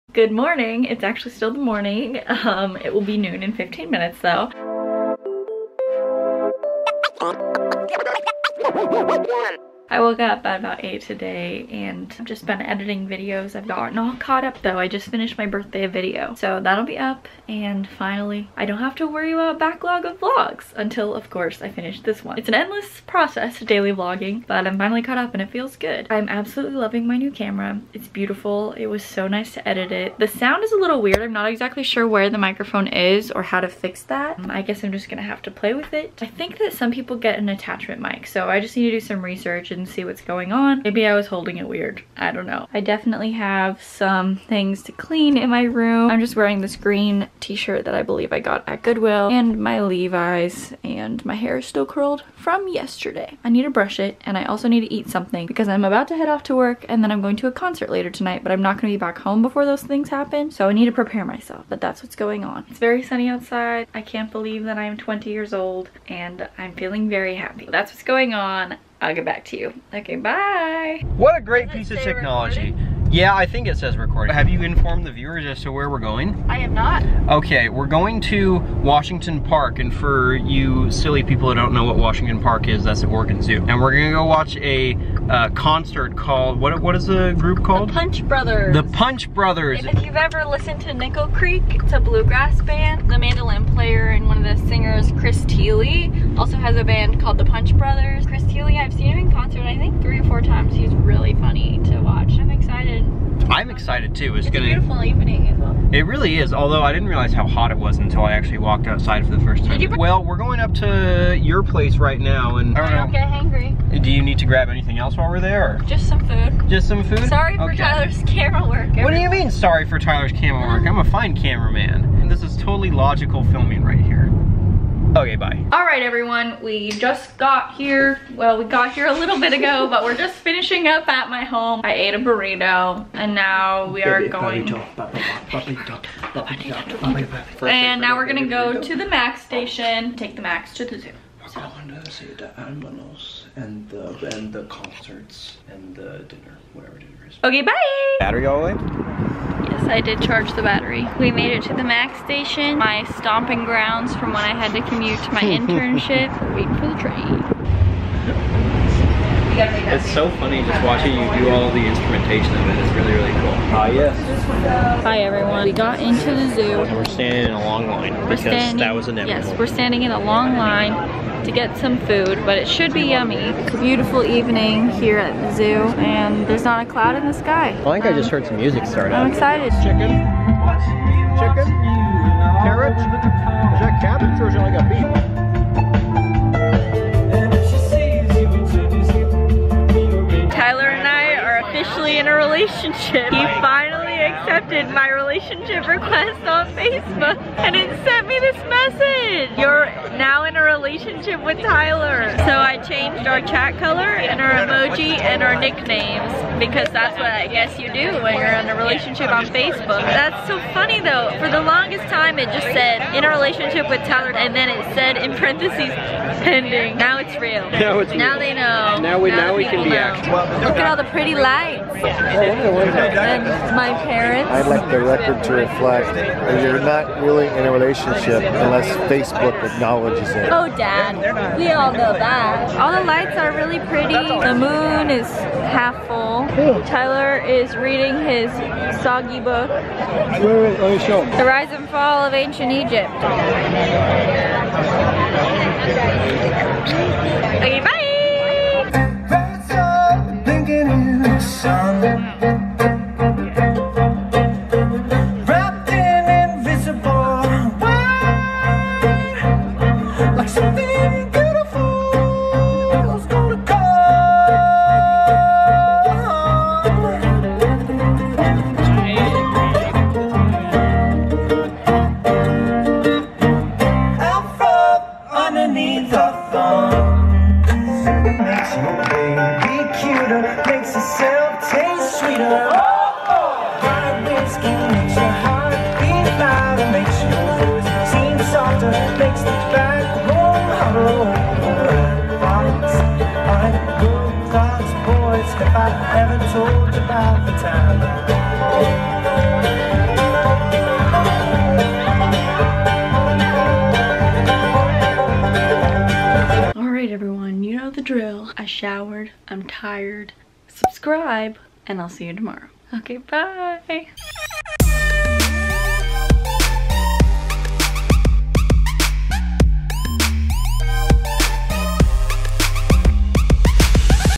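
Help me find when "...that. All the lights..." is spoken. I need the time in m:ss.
3:52.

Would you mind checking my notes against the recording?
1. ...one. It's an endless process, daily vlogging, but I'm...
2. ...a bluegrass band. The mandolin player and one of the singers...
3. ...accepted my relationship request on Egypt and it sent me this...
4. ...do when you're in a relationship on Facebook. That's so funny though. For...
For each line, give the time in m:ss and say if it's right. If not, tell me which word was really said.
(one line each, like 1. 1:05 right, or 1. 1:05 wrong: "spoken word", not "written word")
1. 0:22 right
2. 1:31 right
3. 3:14 wrong: "Facebook", not "Egypt"
4. 3:27 right.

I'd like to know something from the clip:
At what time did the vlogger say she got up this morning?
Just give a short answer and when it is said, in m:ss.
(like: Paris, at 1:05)
8, at 0:10.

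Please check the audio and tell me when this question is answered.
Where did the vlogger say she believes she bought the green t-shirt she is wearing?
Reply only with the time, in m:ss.
0:48.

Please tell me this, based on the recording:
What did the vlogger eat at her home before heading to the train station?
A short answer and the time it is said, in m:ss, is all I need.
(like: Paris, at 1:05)
A burrito, at 2:12.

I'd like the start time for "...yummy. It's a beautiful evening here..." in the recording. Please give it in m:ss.
2:53.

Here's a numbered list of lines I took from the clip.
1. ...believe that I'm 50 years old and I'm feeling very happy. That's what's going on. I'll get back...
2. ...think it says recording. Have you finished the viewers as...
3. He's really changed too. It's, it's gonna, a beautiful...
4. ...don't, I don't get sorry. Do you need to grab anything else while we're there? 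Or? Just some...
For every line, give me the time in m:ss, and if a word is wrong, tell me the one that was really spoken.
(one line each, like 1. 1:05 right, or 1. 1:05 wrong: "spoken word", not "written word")
1. 1:04 wrong: "20", not "50"
2. 1:13 wrong: "informed", not "finished"
3. 1:40 wrong: "excited", not "changed"
4. 1:52 wrong: "hangry", not "sorry".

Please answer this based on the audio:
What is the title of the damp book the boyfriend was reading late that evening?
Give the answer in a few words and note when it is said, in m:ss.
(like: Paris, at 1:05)
The Rise and Fall of Ancient Egypt, at 4:01.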